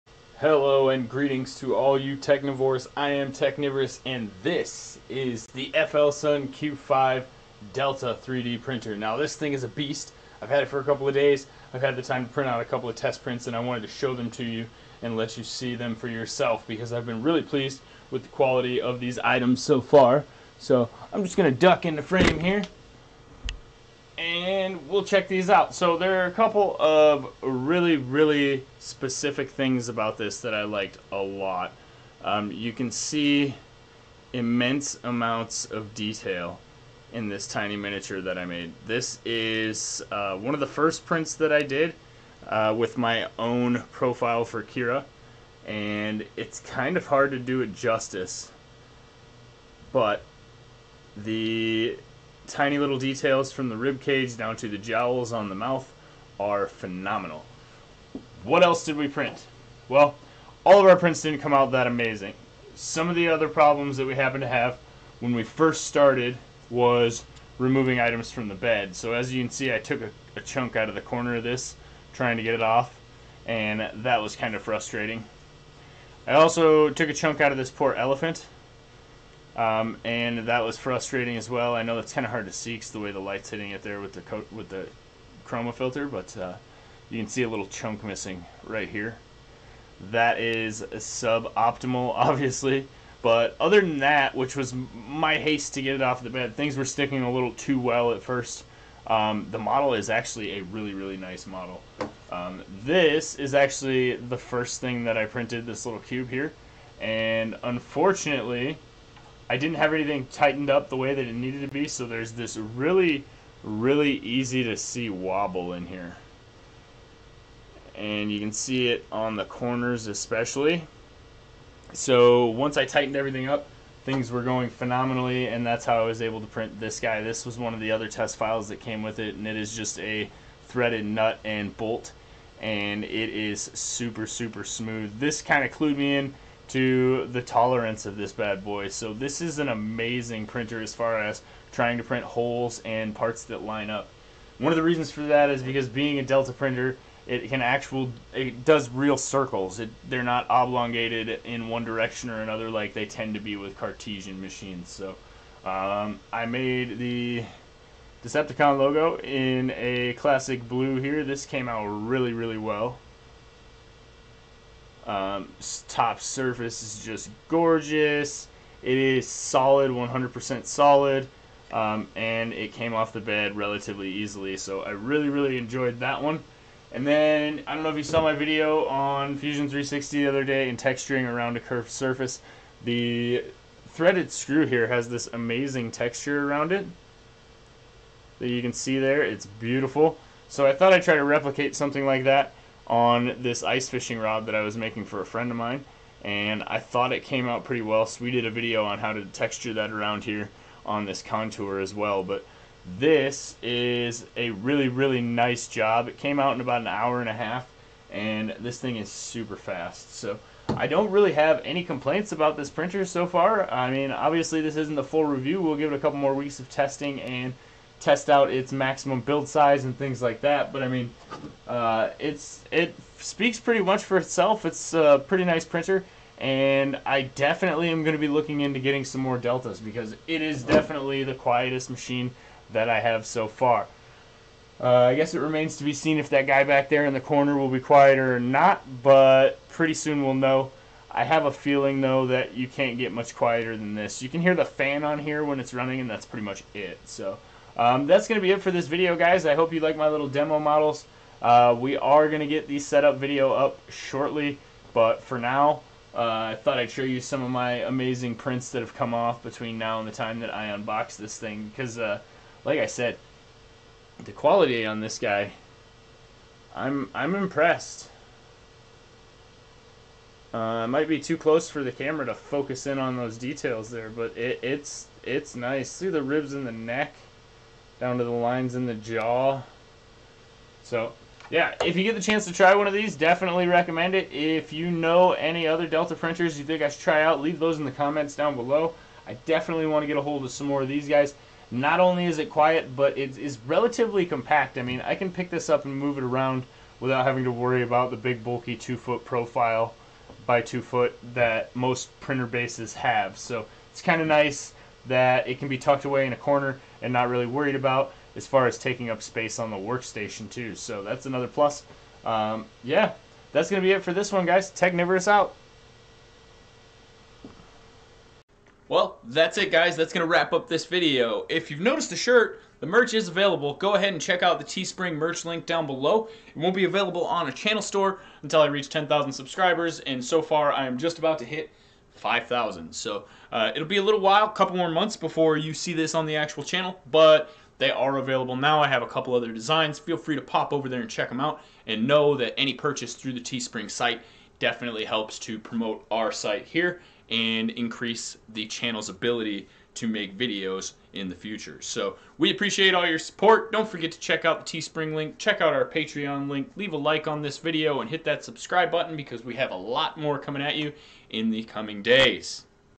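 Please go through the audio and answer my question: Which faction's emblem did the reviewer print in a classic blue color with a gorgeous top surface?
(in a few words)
Decepticon.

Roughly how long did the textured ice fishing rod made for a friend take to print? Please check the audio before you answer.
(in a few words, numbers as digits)
An hour and a half.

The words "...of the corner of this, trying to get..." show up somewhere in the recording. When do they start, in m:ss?
1:10.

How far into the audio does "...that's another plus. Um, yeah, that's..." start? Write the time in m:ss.
5:11.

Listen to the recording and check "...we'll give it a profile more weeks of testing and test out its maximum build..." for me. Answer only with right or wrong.
wrong.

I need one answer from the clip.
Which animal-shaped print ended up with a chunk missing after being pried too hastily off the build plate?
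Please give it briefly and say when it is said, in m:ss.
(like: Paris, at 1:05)
Elephant, at 1:17.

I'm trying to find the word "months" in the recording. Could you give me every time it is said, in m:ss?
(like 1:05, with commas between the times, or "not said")
5:34.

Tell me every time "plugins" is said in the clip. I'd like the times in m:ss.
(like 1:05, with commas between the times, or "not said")
not said.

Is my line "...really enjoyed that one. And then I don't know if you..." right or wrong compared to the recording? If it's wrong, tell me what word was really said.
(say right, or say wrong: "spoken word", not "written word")
right.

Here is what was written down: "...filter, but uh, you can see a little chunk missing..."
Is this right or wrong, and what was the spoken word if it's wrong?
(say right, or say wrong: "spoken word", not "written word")
right.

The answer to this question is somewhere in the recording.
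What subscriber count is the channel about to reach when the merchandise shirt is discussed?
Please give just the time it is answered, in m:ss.
5:32.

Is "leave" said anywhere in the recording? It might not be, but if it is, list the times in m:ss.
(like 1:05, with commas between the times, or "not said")
4:47, 5:56.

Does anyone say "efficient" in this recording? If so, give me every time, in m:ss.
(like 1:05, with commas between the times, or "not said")
not said.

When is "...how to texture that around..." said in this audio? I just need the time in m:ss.
3:18.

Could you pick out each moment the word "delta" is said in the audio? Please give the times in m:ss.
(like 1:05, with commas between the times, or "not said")
0:07, 2:26, 3:49, 4:45.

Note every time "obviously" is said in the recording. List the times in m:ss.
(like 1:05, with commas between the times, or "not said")
1:32, 3:34.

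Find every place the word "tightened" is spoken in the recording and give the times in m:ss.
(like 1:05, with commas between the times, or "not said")
1:50, 2:02.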